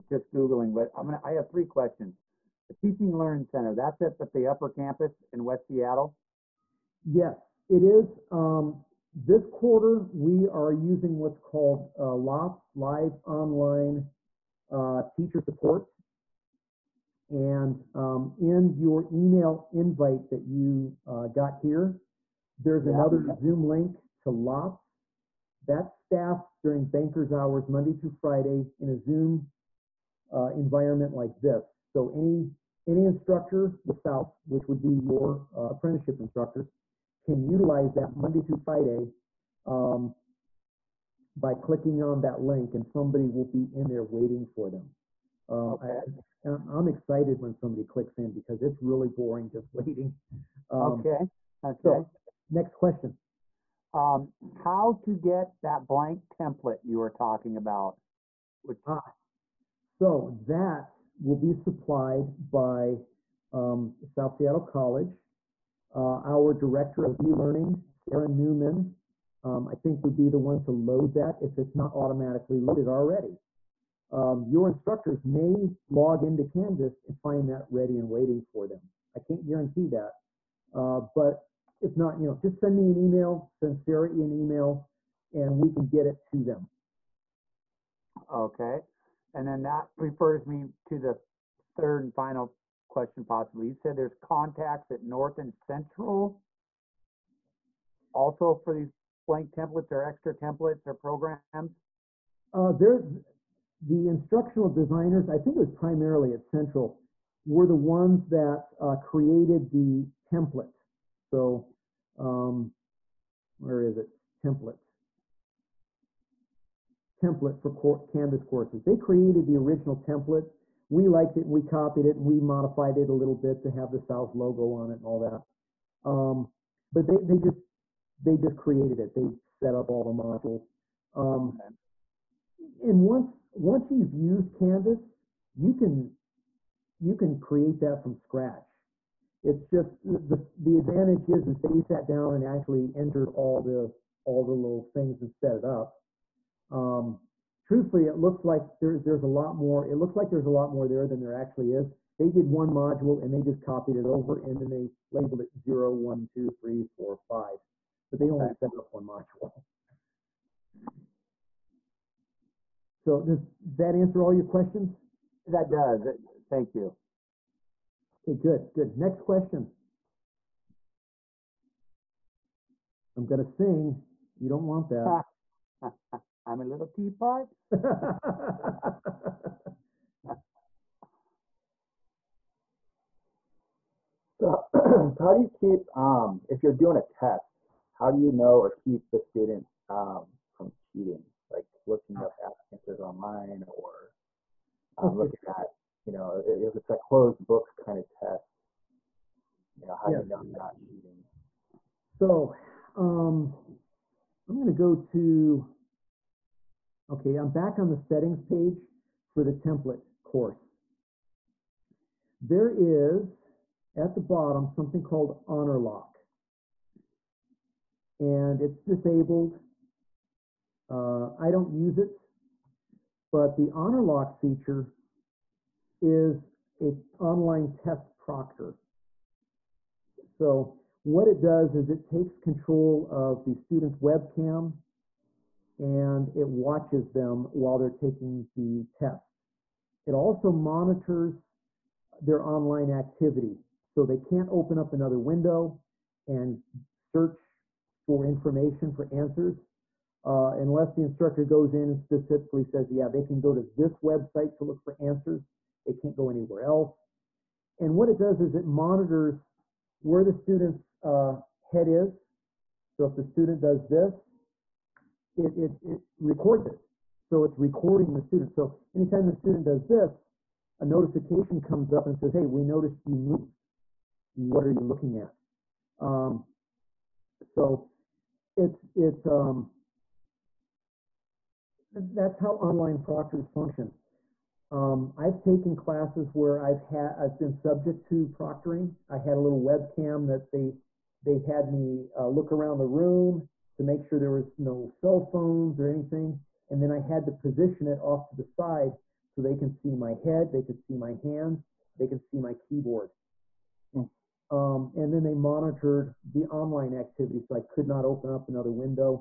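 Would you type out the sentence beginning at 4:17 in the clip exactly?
And what it does is it monitors where the student's uh, head is.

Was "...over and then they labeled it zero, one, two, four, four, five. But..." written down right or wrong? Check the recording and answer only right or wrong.
wrong.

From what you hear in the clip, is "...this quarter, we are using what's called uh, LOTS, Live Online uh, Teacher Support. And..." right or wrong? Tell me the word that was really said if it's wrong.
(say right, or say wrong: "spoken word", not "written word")
right.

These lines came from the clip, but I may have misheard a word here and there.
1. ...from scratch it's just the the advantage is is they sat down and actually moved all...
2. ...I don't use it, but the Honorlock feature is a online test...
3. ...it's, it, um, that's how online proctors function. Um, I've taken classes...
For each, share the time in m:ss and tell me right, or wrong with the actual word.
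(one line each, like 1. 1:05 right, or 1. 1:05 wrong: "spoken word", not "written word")
1. 2:18 wrong: "entered", not "moved"
2. 3:41 right
3. 4:38 right.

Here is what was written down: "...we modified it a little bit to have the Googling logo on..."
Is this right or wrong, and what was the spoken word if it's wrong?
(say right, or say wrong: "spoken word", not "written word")
wrong: "South", not "Googling".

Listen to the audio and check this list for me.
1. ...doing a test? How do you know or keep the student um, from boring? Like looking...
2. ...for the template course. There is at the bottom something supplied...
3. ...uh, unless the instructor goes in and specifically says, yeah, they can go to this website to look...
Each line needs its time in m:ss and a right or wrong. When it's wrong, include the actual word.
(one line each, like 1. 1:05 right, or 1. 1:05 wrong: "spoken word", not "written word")
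1. 3:06 wrong: "cheating", not "boring"
2. 3:29 wrong: "called", not "supplied"
3. 4:10 right.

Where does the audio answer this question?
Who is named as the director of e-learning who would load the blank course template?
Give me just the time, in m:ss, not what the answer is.
1:07.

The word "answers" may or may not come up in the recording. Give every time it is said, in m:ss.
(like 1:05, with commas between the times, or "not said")
2:43, 3:12, 4:09, 4:14.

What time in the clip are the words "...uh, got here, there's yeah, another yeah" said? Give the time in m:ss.
0:21.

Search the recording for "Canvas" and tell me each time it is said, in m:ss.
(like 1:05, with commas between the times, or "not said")
1:16, 1:57, 2:14.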